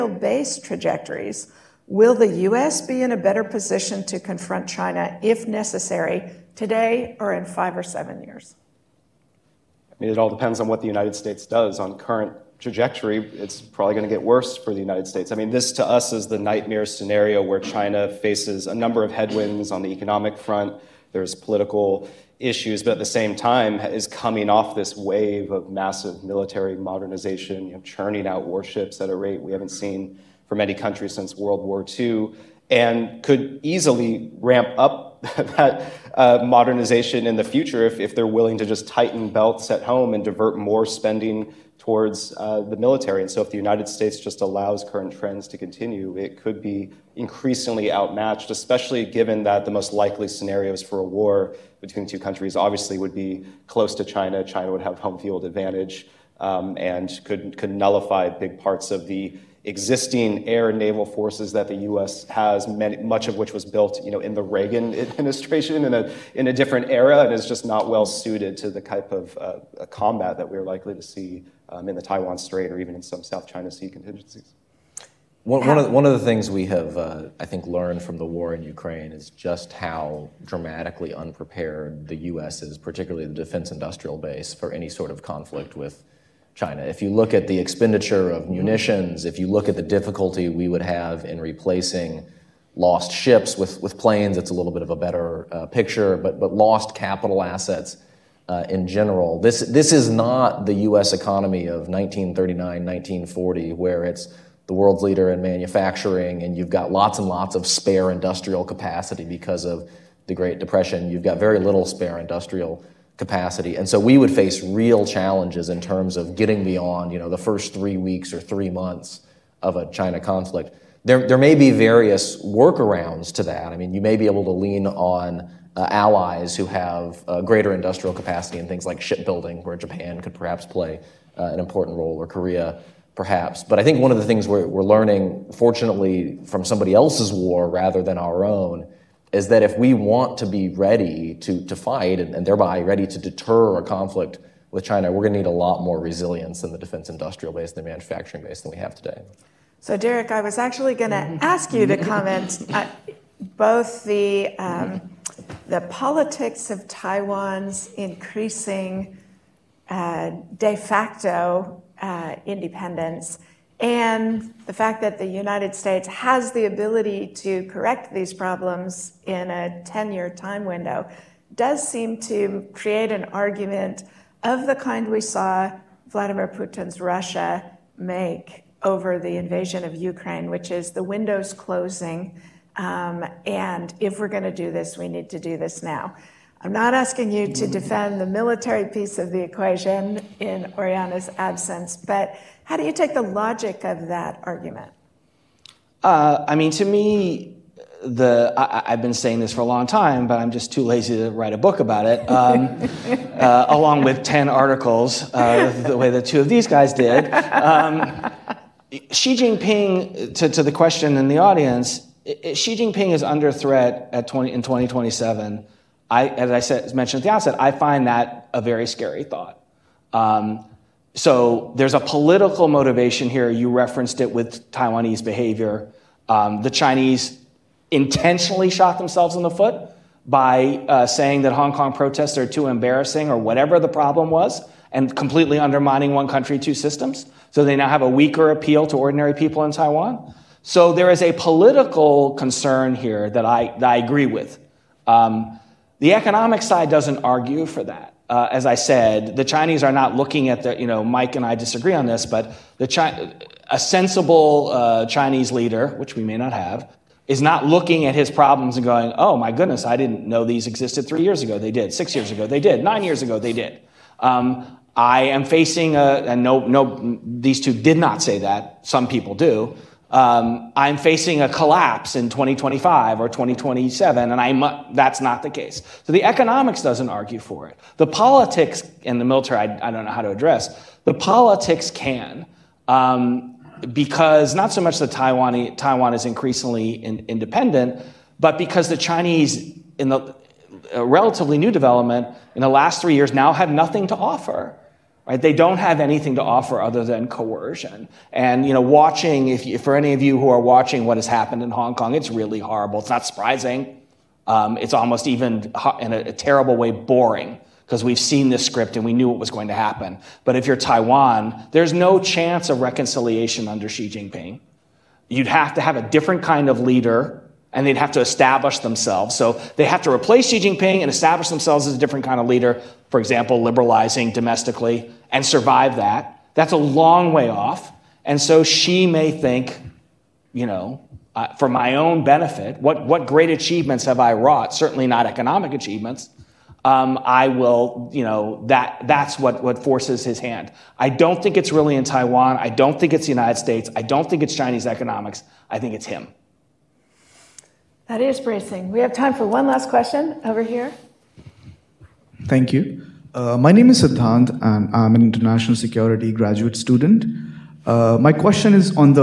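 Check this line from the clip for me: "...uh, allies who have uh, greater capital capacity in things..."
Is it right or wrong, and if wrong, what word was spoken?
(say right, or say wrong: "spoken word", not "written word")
wrong: "industrial", not "capital".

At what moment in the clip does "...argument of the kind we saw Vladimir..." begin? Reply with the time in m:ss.
2:53.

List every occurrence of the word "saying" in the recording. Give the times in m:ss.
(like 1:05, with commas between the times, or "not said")
3:19, 3:51.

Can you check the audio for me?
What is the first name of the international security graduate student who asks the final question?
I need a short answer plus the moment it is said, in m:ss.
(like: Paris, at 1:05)
Siddhant, at 5:54.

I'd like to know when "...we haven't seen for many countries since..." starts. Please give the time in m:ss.
0:29.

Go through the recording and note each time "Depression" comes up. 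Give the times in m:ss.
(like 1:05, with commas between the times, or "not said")
1:50.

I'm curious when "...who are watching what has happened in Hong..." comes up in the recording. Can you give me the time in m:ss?
5:00.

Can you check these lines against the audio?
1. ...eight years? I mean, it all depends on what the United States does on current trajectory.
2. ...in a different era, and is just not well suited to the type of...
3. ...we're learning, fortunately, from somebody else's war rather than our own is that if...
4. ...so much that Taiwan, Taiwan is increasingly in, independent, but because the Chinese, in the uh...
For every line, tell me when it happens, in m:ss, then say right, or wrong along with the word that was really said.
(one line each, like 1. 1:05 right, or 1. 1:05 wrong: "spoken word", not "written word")
1. 0:07 wrong: "seven", not "eight"
2. 1:06 right
3. 2:14 right
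4. 4:44 right.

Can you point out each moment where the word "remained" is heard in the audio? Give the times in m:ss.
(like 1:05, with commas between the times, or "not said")
not said.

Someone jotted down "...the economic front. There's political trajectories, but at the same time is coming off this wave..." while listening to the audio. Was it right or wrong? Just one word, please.
wrong.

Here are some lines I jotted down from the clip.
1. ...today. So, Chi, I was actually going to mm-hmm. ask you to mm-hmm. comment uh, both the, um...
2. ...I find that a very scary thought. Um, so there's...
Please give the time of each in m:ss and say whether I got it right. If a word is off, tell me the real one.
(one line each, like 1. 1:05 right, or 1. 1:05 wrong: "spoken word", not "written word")
1. 2:28 wrong: "Derek", not "Chi"
2. 3:37 right.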